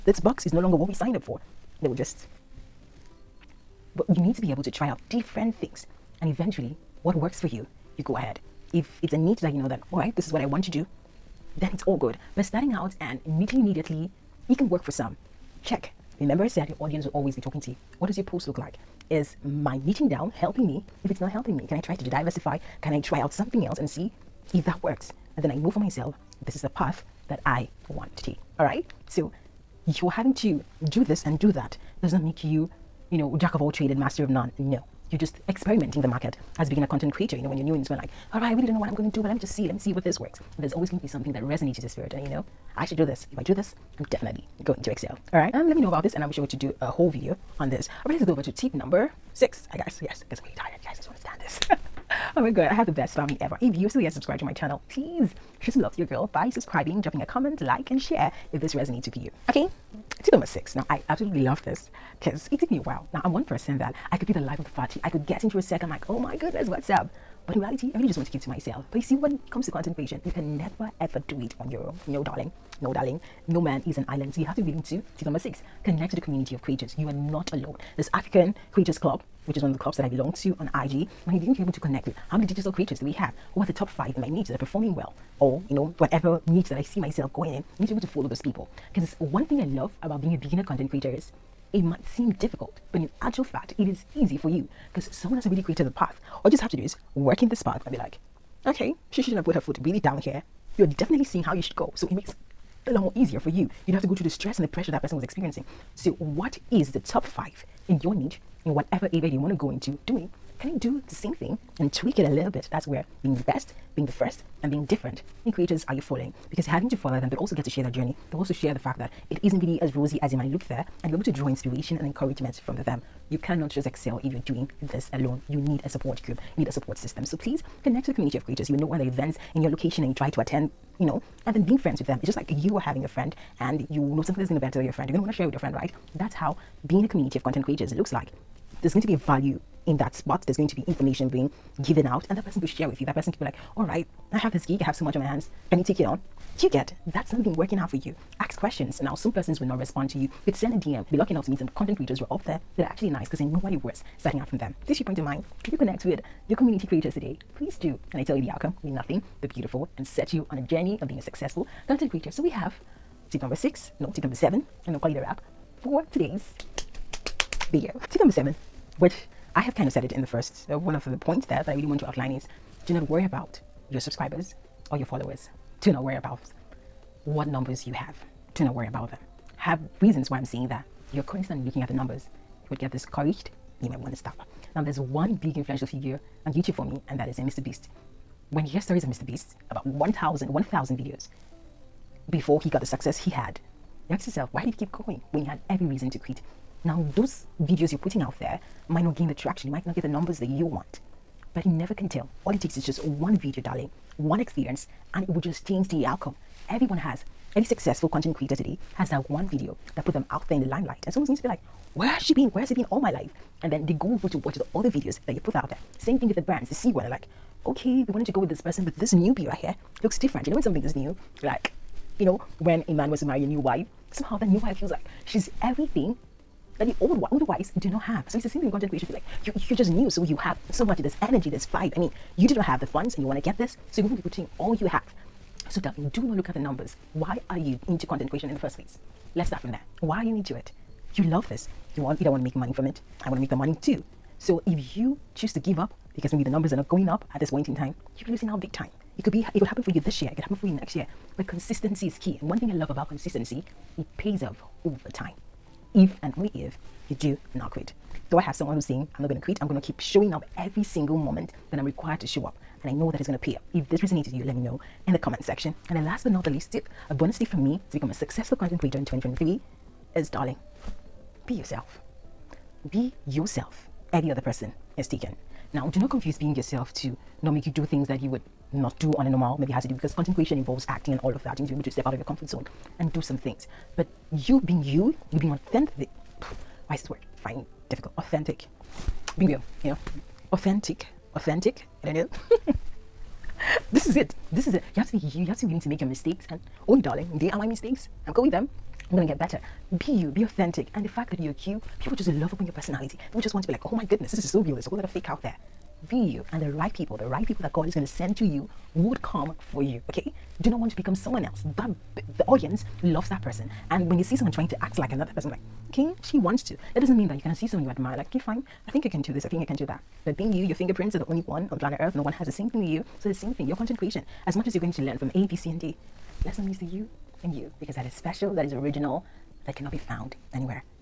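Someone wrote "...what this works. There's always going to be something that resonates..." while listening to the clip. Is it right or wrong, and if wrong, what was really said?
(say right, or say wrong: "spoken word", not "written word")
right.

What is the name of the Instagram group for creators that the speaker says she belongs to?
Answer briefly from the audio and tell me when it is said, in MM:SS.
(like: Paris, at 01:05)
African Creators Club, at 01:18.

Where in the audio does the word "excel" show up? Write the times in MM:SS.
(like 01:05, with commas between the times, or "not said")
00:44, 02:03.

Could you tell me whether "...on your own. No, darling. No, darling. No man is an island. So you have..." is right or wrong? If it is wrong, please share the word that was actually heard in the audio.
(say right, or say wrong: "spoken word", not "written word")
right.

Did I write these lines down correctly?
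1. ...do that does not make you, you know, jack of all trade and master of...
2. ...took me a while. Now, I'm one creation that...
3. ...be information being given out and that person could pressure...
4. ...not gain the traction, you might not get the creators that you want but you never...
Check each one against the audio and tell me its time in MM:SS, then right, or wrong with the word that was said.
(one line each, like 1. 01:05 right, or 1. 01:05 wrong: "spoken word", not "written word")
1. 00:31 right
2. 01:02 wrong: "person", not "creation"
3. 02:20 wrong: "share", not "pressure"
4. 03:19 wrong: "numbers", not "creators".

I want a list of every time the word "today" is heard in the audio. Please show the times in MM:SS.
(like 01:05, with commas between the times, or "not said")
02:37, 02:46, 03:28.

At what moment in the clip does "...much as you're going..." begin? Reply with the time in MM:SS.
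05:24.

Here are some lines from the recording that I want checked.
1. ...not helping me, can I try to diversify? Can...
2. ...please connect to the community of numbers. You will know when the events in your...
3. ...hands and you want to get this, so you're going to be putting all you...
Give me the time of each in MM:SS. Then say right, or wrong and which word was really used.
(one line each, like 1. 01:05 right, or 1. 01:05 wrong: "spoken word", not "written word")
1. 00:21 right
2. 02:07 wrong: "creators", not "numbers"
3. 03:52 wrong: "funds", not "hands".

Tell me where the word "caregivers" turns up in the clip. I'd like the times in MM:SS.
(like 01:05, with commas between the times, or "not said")
not said.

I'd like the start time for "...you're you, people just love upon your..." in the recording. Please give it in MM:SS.
05:01.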